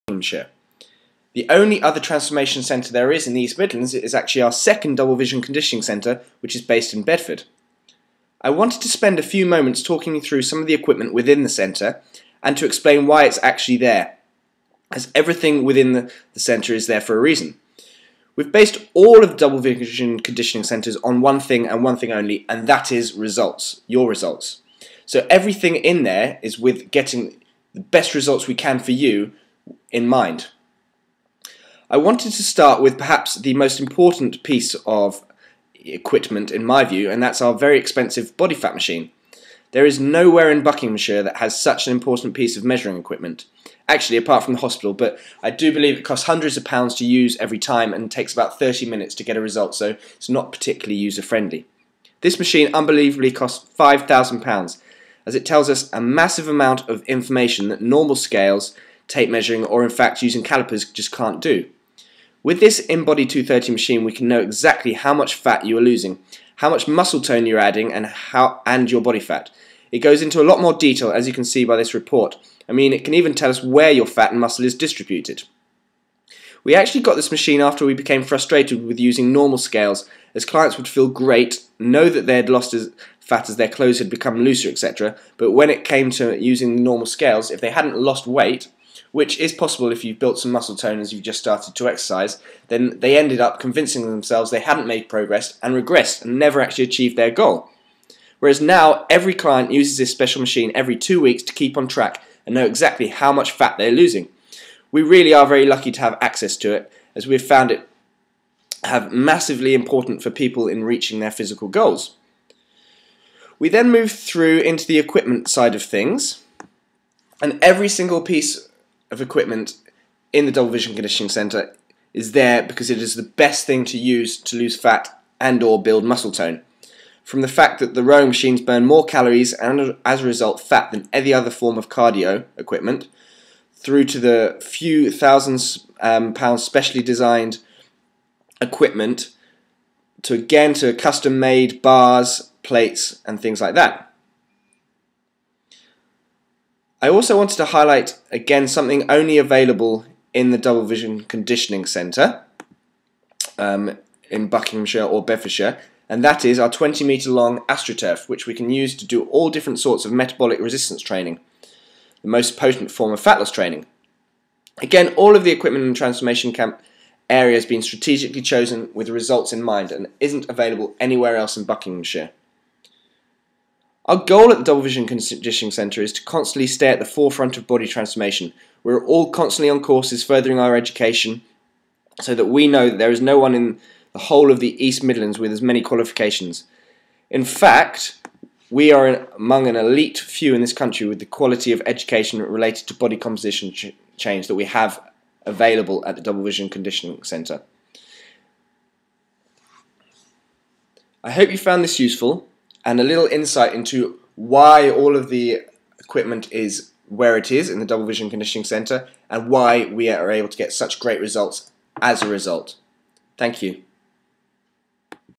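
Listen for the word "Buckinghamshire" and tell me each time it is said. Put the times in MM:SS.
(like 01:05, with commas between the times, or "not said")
00:40, 02:34, 02:51.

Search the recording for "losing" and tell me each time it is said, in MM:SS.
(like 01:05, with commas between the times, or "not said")
01:05, 01:43.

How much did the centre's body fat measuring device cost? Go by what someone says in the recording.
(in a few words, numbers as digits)
£5,000.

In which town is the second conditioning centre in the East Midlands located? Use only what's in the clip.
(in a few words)
Bedford.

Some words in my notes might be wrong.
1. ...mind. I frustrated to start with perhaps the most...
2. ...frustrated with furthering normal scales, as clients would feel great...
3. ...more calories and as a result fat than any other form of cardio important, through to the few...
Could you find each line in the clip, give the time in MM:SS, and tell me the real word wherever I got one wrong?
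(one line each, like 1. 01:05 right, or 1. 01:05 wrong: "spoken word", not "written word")
1. 00:30 wrong: "wanted", not "frustrated"
2. 01:18 wrong: "using", not "furthering"
3. 02:08 wrong: "equipment", not "important".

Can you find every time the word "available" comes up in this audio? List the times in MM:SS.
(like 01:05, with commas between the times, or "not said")
02:29, 02:50, 03:15.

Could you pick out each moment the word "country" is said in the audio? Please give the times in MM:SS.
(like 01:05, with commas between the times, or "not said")
03:10.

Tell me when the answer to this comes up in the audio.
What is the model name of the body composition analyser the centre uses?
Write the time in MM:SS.
01:02.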